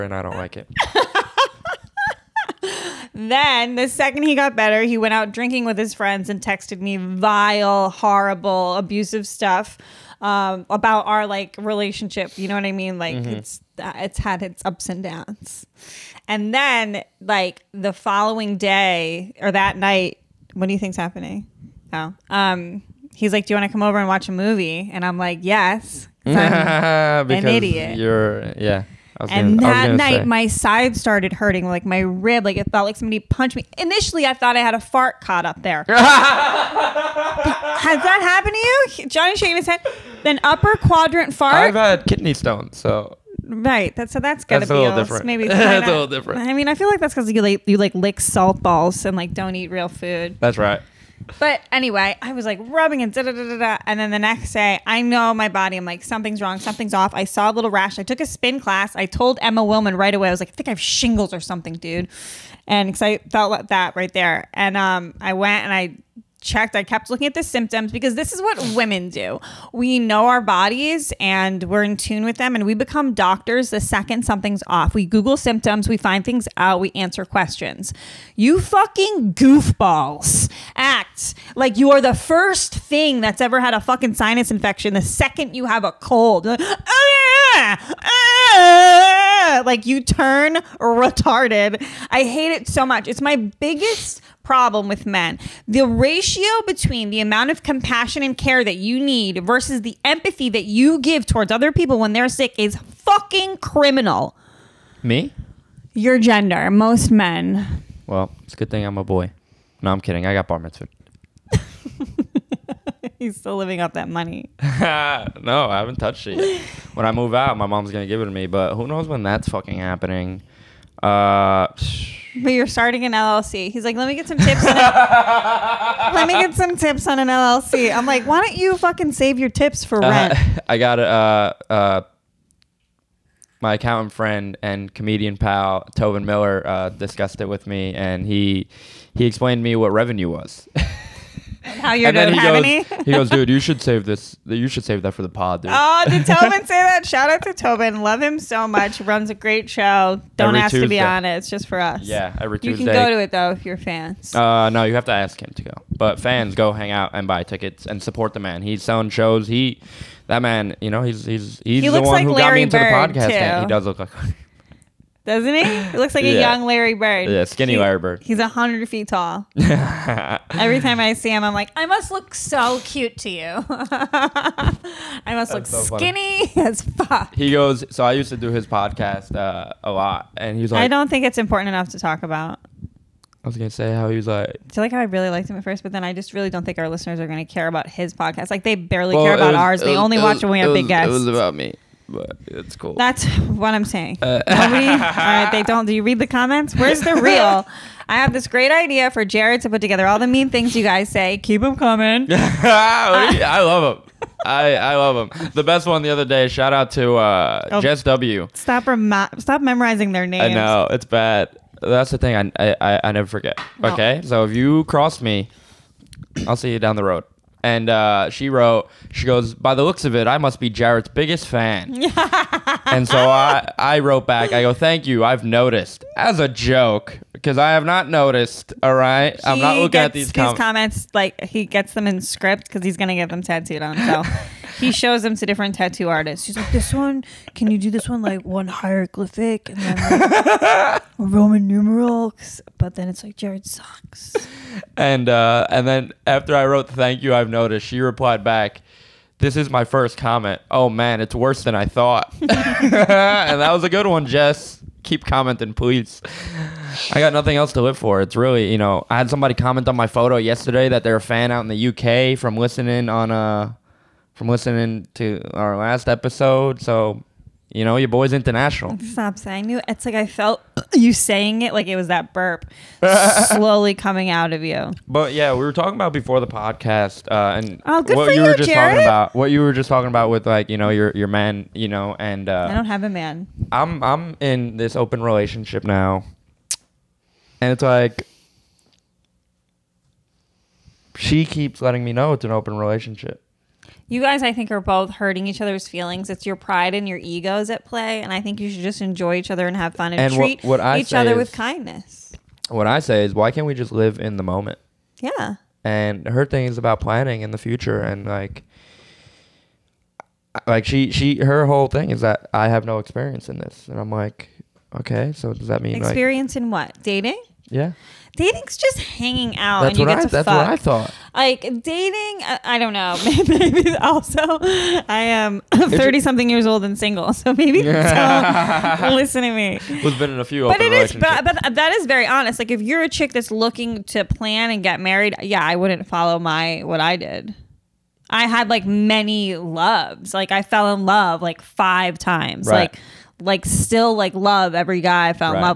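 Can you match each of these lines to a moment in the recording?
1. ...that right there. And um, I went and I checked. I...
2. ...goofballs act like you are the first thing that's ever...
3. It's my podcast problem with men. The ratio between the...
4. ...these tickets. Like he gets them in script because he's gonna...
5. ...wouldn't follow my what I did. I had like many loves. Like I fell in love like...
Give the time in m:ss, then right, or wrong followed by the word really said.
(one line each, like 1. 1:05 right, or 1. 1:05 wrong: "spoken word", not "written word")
1. 1:03 right
2. 1:19 right
3. 1:33 wrong: "biggest", not "podcast"
4. 3:50 wrong: "comments", not "tickets"
5. 5:35 right.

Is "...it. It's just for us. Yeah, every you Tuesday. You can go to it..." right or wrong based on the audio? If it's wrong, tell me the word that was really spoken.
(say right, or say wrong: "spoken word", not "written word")
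right.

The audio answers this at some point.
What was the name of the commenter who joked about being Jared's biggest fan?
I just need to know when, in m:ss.
3:27.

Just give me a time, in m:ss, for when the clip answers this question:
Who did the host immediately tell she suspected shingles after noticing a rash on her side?
0:59.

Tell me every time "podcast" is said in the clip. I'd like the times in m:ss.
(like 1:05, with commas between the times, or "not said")
2:43, 2:58, 3:08, 4:36.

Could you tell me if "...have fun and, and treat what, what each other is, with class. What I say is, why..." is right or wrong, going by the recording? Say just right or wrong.
wrong.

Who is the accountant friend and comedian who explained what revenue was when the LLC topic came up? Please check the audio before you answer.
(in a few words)
Tobin Miller.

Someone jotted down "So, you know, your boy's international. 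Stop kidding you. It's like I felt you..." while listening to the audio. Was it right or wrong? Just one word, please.
wrong.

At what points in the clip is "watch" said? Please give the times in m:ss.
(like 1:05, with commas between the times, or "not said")
0:24, 3:10.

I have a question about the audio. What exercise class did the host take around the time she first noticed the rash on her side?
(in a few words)
Spin class.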